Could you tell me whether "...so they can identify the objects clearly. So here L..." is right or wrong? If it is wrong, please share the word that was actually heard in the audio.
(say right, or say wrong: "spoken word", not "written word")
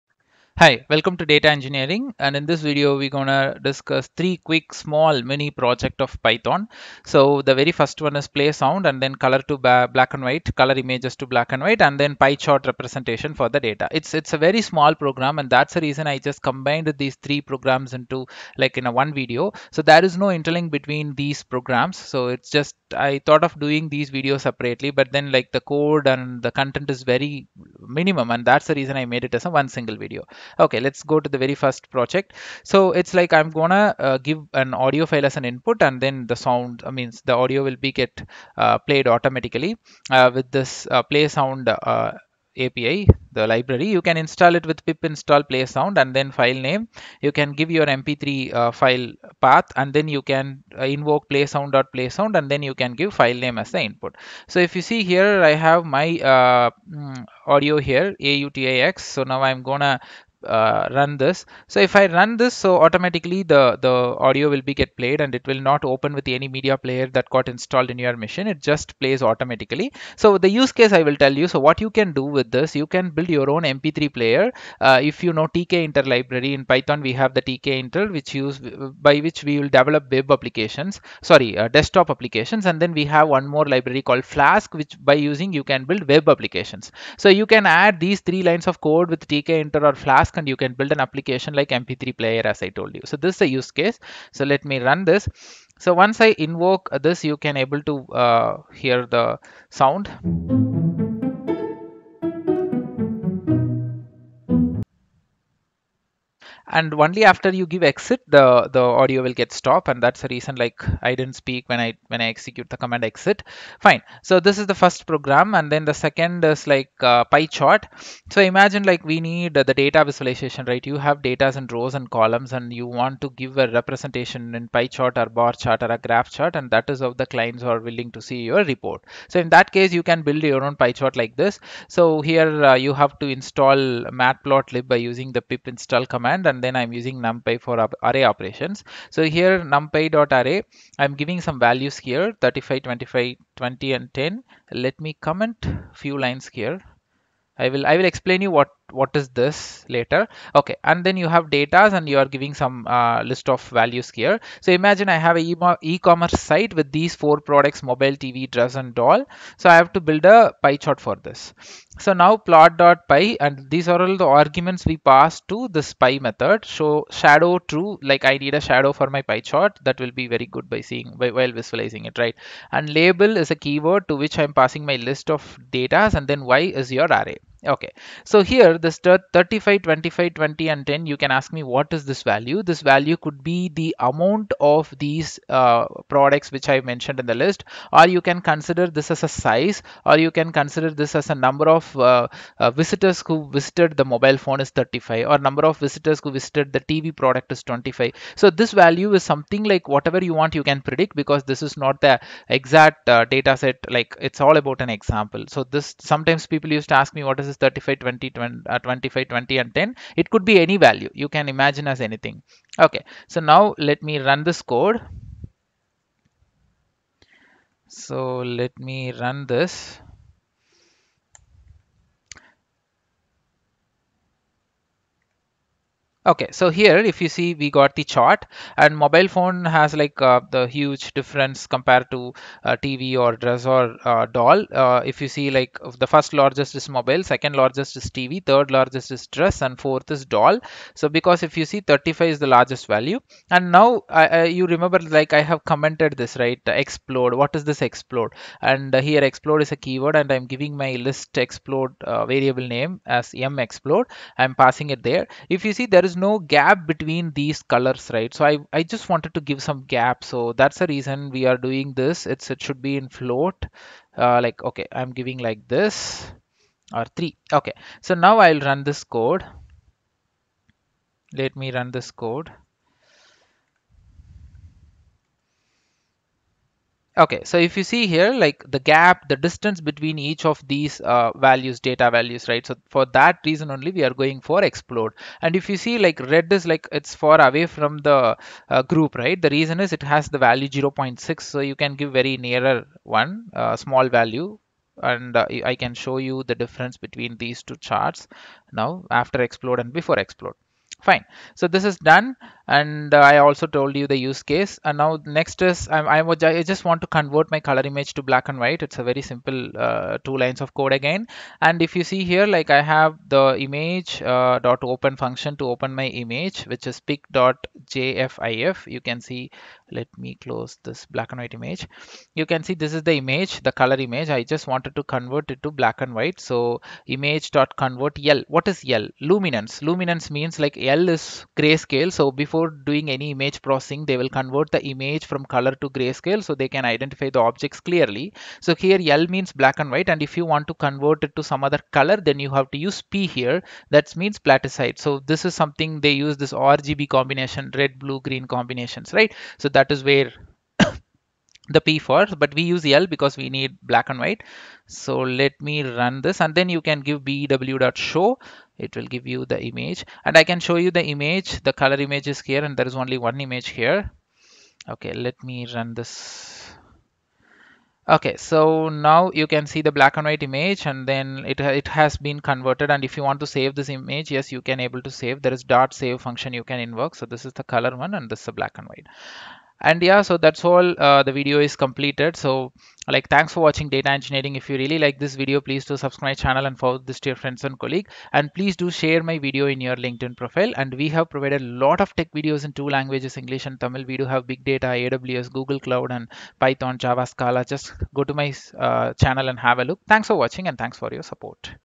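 right.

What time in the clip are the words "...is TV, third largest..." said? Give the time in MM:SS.
03:57.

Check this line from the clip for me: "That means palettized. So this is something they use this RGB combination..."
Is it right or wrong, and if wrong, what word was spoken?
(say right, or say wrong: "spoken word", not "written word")
right.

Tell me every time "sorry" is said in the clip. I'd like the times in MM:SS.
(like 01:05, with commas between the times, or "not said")
01:21.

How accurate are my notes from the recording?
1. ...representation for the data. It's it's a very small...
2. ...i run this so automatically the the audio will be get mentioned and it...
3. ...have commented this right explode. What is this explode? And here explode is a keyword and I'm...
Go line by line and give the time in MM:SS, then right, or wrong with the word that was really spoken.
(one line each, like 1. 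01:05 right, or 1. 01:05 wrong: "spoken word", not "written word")
1. 00:12 right
2. 01:01 wrong: "played", not "mentioned"
3. 04:05 right.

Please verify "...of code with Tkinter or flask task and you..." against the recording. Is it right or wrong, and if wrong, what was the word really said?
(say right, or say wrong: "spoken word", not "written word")
right.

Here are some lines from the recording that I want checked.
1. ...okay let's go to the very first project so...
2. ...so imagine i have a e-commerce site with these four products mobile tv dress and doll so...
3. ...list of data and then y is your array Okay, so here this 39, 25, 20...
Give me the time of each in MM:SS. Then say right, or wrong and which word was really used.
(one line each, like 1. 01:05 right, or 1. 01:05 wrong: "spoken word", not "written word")
1. 00:30 right
2. 02:34 right
3. 02:54 wrong: "35", not "39".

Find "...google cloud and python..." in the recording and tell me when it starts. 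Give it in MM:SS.
06:35.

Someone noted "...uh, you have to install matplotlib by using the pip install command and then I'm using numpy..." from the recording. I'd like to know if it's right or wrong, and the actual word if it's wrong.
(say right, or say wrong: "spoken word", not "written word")
right.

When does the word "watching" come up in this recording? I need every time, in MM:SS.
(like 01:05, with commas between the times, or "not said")
06:23, 06:40.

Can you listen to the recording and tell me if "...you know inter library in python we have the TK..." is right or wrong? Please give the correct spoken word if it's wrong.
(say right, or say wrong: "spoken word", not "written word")
right.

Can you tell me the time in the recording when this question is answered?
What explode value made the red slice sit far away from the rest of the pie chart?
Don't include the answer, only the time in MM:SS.
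04:50.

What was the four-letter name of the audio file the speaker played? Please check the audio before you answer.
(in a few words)
AUTIX.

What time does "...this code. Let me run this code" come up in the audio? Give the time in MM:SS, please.
04:28.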